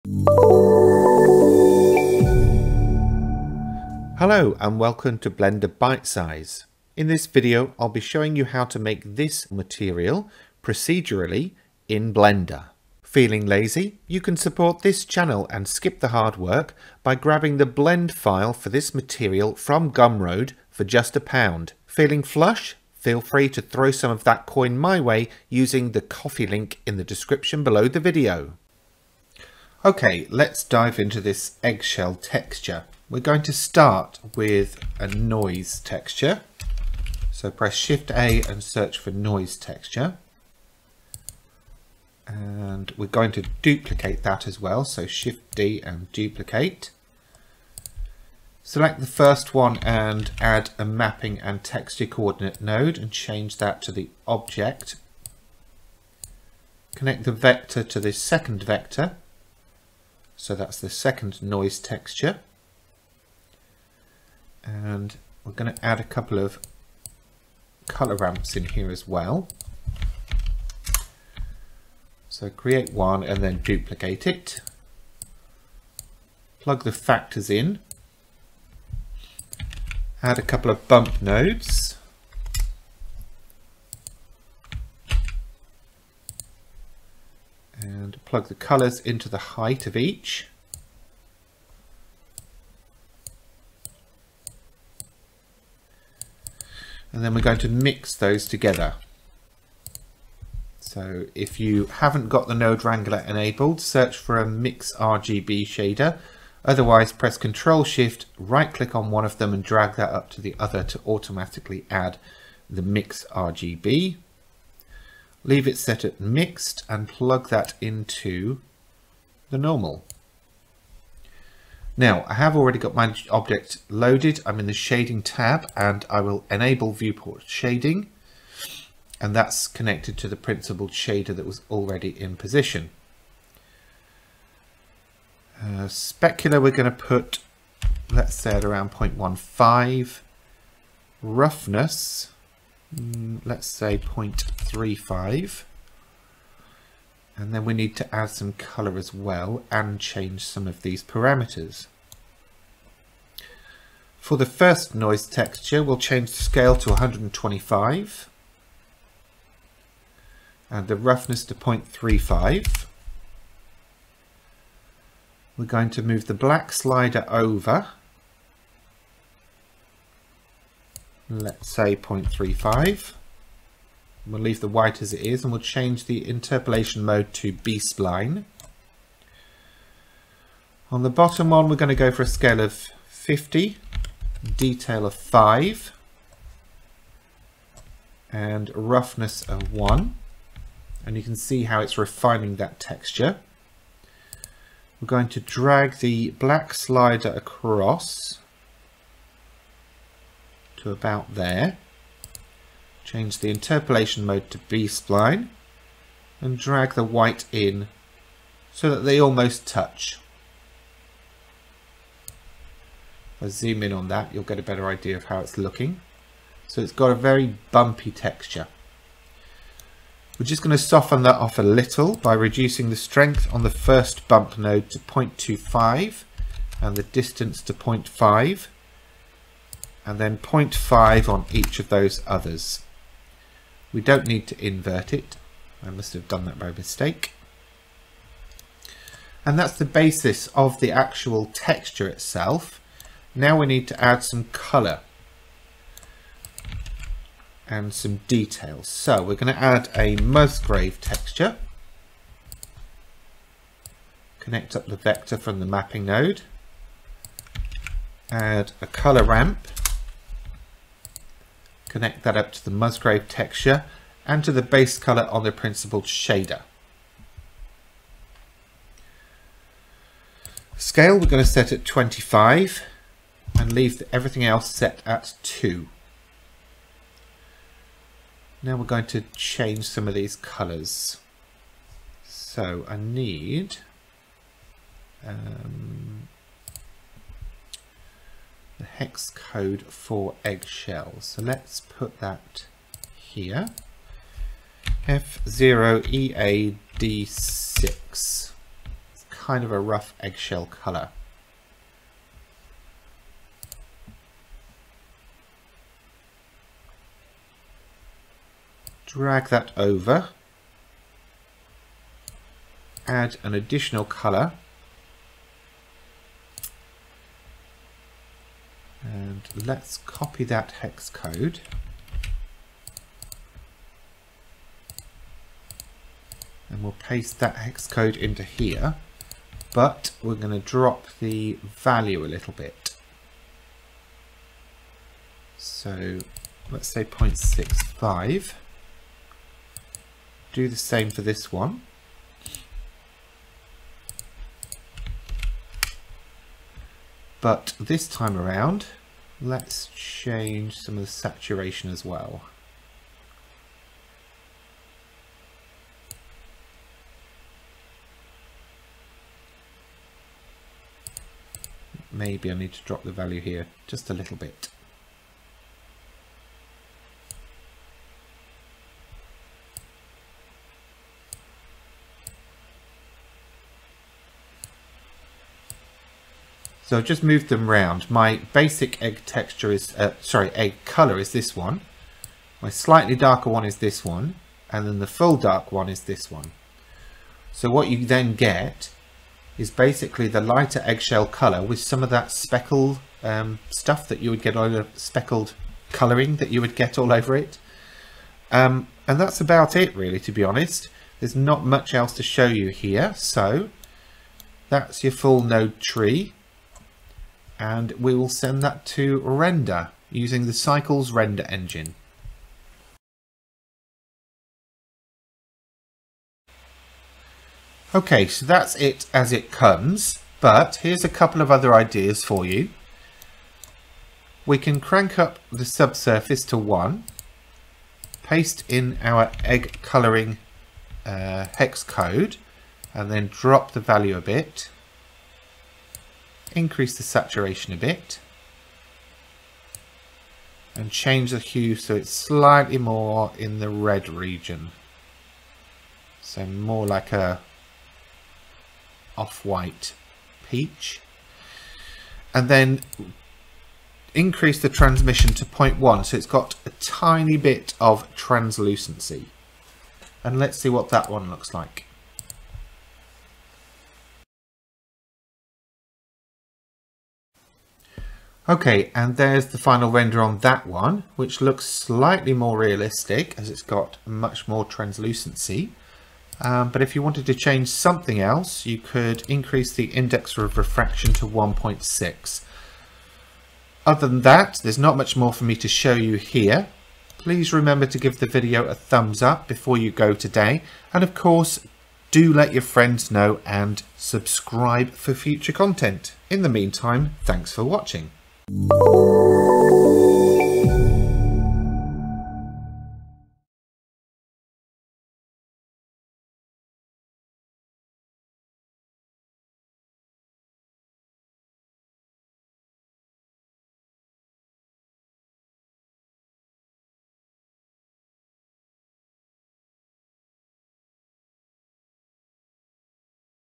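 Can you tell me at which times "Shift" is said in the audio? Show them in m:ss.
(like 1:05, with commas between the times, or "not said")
0:37, 0:45, 1:47.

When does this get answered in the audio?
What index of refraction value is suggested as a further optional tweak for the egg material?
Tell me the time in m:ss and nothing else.
8:01.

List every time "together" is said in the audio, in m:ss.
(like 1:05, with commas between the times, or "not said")
1:38.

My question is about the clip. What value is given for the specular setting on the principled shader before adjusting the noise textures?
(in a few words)
0.15.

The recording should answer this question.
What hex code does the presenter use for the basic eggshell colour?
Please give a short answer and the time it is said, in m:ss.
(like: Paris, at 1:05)
F0EAD6, at 4:55.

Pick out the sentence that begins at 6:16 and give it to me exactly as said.
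So I've just moved them round.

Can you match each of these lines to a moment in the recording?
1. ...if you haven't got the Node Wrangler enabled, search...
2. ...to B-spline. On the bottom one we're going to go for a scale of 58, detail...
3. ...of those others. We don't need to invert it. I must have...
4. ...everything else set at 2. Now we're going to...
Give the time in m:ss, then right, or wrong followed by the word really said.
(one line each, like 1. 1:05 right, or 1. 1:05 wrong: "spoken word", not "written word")
1. 1:41 right
2. 2:57 wrong: "50", not "58"
3. 3:51 right
4. 4:34 right.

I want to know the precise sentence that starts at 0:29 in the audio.
Okay, let's dive into this eggshell texture.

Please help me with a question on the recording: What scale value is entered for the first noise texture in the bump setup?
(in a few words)
125.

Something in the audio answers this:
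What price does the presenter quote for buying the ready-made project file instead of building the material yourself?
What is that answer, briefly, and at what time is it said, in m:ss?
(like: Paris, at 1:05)
1 pound, at 0:20.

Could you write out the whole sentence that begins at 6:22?
My slightly darker one is this one.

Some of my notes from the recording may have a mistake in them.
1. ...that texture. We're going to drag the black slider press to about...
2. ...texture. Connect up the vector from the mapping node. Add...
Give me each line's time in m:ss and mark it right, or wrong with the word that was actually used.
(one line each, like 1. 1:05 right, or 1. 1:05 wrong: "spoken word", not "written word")
1. 3:12 wrong: "across", not "press"
2. 4:10 right.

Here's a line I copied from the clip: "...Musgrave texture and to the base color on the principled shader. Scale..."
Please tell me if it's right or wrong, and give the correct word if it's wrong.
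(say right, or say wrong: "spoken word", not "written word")
right.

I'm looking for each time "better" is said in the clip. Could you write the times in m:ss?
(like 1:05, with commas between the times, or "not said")
3:34.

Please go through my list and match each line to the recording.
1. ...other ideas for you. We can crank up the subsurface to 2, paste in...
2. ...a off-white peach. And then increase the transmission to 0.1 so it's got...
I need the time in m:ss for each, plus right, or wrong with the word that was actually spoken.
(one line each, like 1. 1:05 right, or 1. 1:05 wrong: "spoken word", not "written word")
1. 7:01 wrong: "1", not "2"
2. 7:27 right.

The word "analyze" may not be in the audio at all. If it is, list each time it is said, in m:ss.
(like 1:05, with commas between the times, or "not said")
not said.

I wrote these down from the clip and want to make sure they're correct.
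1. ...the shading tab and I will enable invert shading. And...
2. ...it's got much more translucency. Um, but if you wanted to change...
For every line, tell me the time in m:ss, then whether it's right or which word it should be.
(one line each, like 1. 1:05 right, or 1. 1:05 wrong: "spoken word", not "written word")
1. 2:04 wrong: "viewport", not "invert"
2. 7:53 right.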